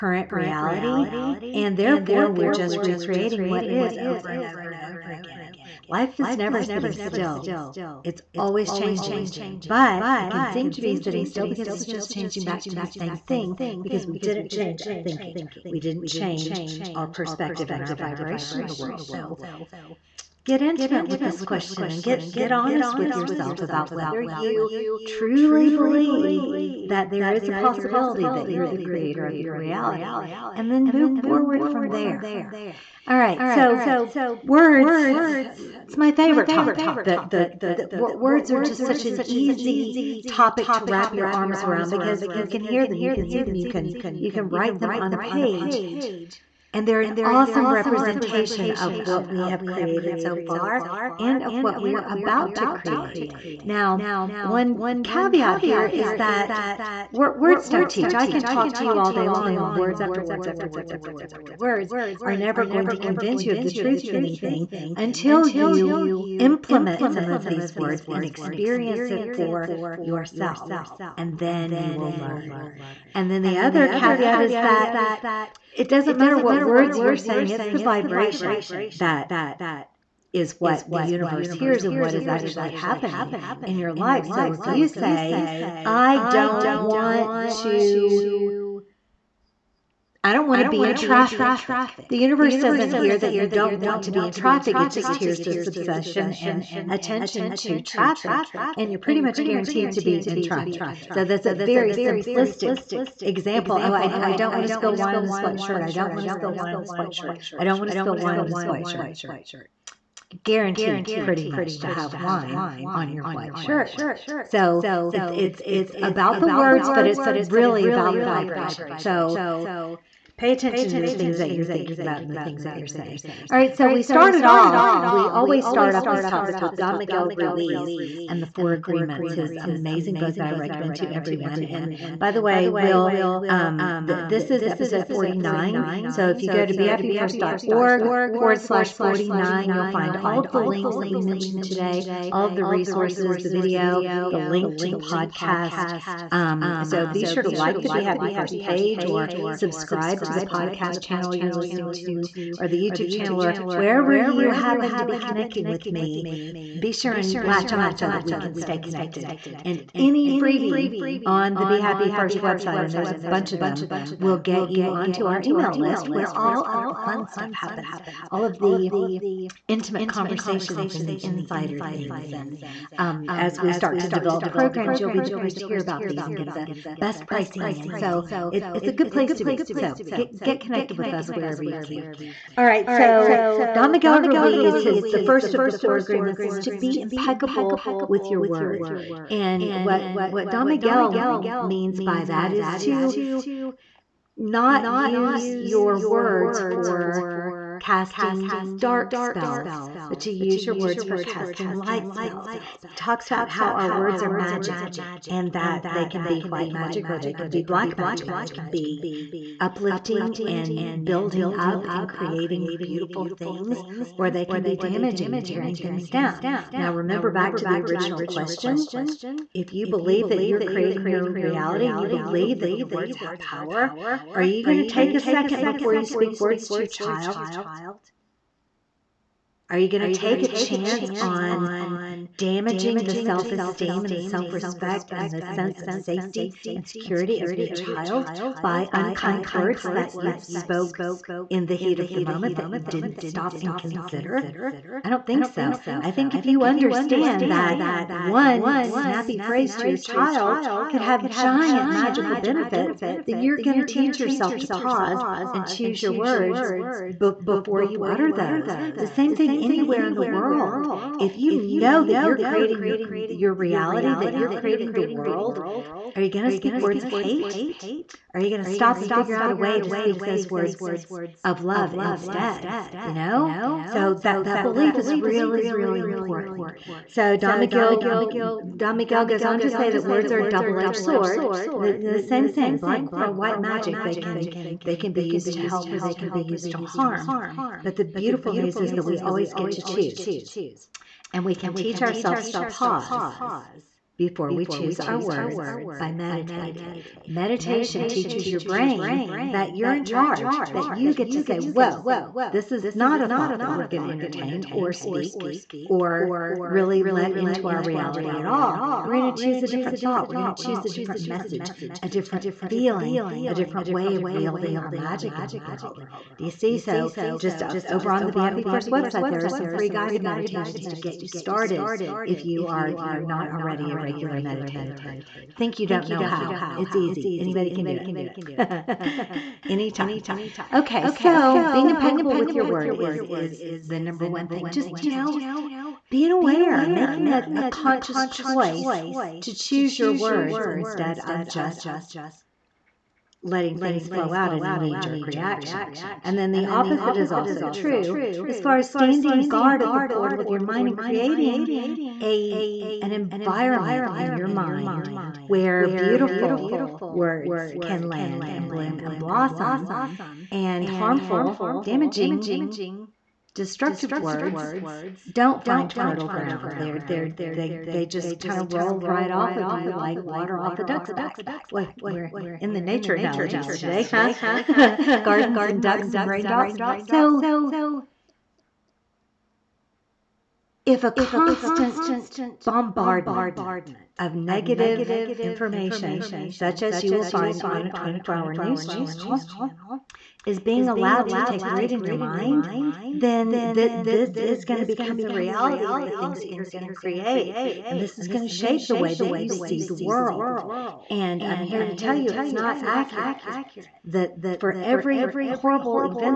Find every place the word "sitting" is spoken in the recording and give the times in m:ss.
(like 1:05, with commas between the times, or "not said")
0:06, 0:10.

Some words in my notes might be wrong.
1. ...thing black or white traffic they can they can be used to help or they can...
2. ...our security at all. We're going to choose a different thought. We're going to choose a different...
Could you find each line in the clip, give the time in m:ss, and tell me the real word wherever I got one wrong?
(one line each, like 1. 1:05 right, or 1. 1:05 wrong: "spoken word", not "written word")
1. 4:42 wrong: "magic", not "traffic"
2. 5:07 wrong: "reality", not "security".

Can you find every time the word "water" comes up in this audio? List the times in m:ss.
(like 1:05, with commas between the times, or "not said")
6:10.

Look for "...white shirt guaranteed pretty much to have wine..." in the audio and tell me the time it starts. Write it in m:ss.
1:48.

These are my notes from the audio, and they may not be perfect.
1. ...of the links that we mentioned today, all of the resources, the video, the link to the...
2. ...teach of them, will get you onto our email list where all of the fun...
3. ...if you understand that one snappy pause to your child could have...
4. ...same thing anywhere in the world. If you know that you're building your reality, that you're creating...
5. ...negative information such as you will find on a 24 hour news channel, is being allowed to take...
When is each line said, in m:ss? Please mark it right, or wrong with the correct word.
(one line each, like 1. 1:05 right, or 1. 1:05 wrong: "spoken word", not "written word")
1. 2:20 right
2. 2:43 wrong: "bunch", not "teach"
3. 4:06 wrong: "phrase", not "pause"
4. 4:19 wrong: "creating", not "building"
5. 6:24 right.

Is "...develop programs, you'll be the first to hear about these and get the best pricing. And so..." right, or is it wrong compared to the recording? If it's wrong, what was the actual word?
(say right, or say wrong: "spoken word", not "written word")
right.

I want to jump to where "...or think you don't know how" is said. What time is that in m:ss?
5:24.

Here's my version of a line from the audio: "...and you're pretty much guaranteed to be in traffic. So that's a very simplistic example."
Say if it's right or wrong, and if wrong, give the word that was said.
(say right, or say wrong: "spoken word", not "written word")
right.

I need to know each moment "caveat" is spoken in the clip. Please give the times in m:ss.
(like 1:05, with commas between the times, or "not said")
0:55, 1:13.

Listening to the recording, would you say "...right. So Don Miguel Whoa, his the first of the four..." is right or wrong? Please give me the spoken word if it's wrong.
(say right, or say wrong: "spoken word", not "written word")
wrong: "Ruiz", not "Whoa".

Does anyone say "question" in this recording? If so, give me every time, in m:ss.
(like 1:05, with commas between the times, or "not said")
0:21, 3:38.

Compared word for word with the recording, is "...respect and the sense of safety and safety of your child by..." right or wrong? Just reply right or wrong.
wrong.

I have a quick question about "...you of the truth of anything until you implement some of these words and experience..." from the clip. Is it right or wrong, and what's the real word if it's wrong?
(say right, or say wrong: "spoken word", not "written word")
right.